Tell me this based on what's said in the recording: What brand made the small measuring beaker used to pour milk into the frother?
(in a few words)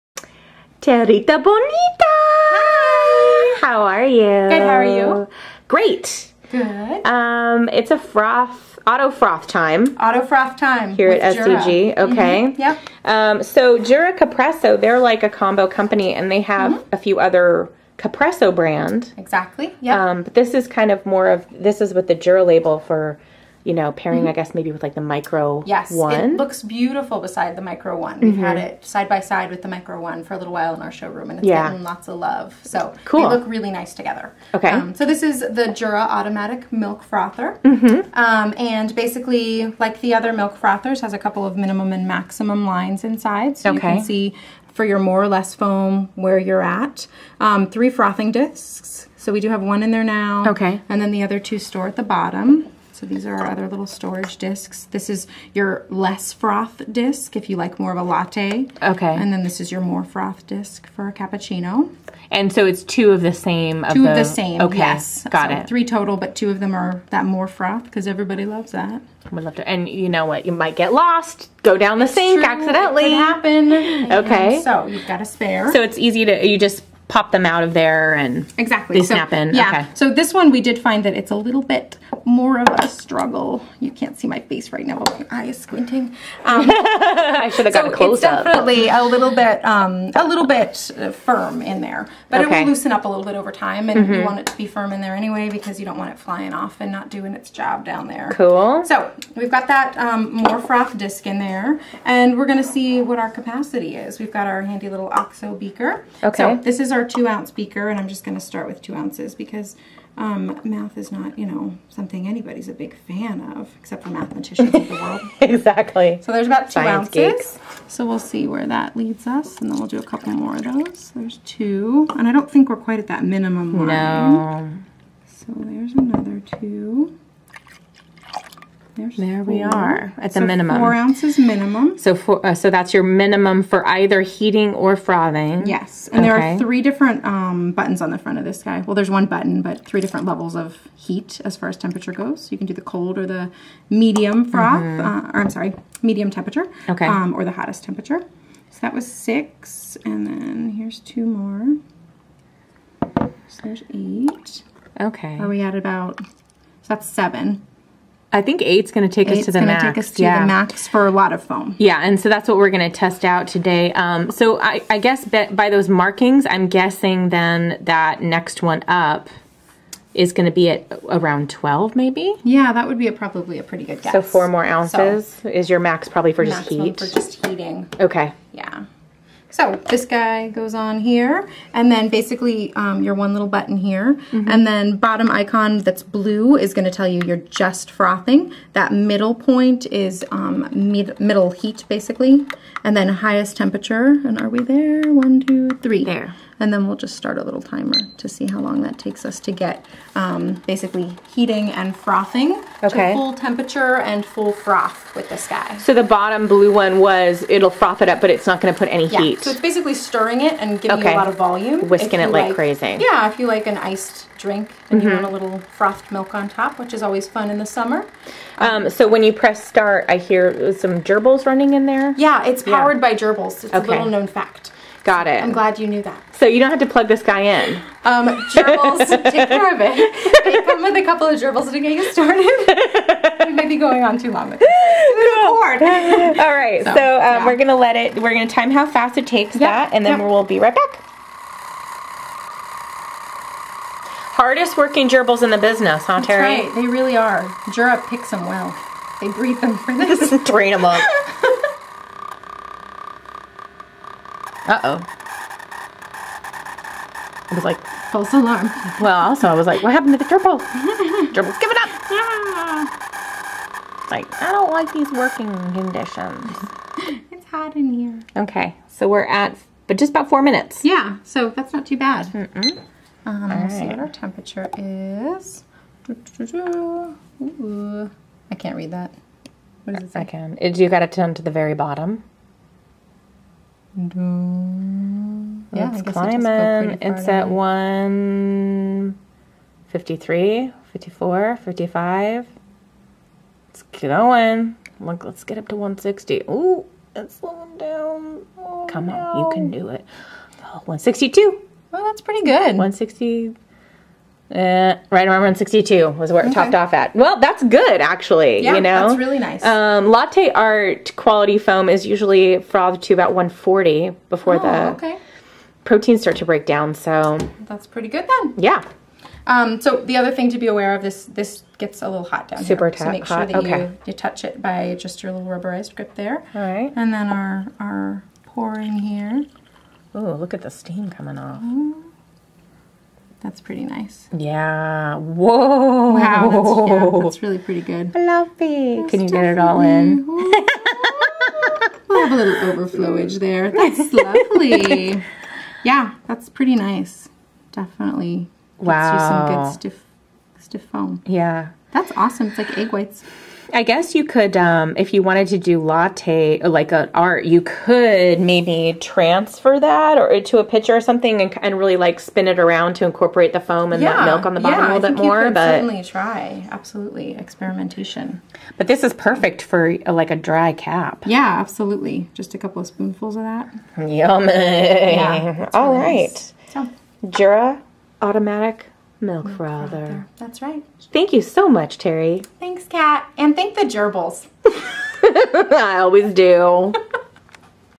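OXO.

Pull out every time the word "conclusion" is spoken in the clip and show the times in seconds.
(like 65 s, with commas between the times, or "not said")
not said.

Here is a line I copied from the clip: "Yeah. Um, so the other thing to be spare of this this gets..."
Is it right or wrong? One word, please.
wrong.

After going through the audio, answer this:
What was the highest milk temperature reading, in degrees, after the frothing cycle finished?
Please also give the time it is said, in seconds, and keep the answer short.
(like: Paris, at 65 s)
162, at 300 s.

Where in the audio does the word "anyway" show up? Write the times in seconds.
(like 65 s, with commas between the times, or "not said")
95 s.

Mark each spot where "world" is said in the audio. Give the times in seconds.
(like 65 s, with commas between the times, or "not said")
114 s.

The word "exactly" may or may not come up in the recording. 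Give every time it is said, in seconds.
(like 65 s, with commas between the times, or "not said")
19 s, 78 s, 115 s.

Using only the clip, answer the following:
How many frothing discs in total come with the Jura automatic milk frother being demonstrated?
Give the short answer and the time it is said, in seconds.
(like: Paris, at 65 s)
3, at 65 s.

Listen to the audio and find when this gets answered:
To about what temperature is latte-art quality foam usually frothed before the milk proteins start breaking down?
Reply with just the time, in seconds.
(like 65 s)
313 s.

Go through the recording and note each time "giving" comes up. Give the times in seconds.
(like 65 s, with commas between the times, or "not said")
210 s, 261 s.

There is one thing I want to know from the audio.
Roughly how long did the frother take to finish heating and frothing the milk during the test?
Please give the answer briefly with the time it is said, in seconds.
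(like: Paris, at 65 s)
About 4 minutes, at 269 s.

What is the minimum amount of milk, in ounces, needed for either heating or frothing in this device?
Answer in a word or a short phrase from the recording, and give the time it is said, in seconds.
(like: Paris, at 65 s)
4 ounces, at 130 s.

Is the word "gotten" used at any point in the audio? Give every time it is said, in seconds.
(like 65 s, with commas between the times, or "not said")
31 s, 87 s.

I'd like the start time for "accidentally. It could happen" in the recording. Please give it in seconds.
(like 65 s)
72 s.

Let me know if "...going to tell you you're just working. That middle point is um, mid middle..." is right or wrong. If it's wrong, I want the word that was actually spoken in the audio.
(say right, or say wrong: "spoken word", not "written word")
wrong: "frothing", not "working".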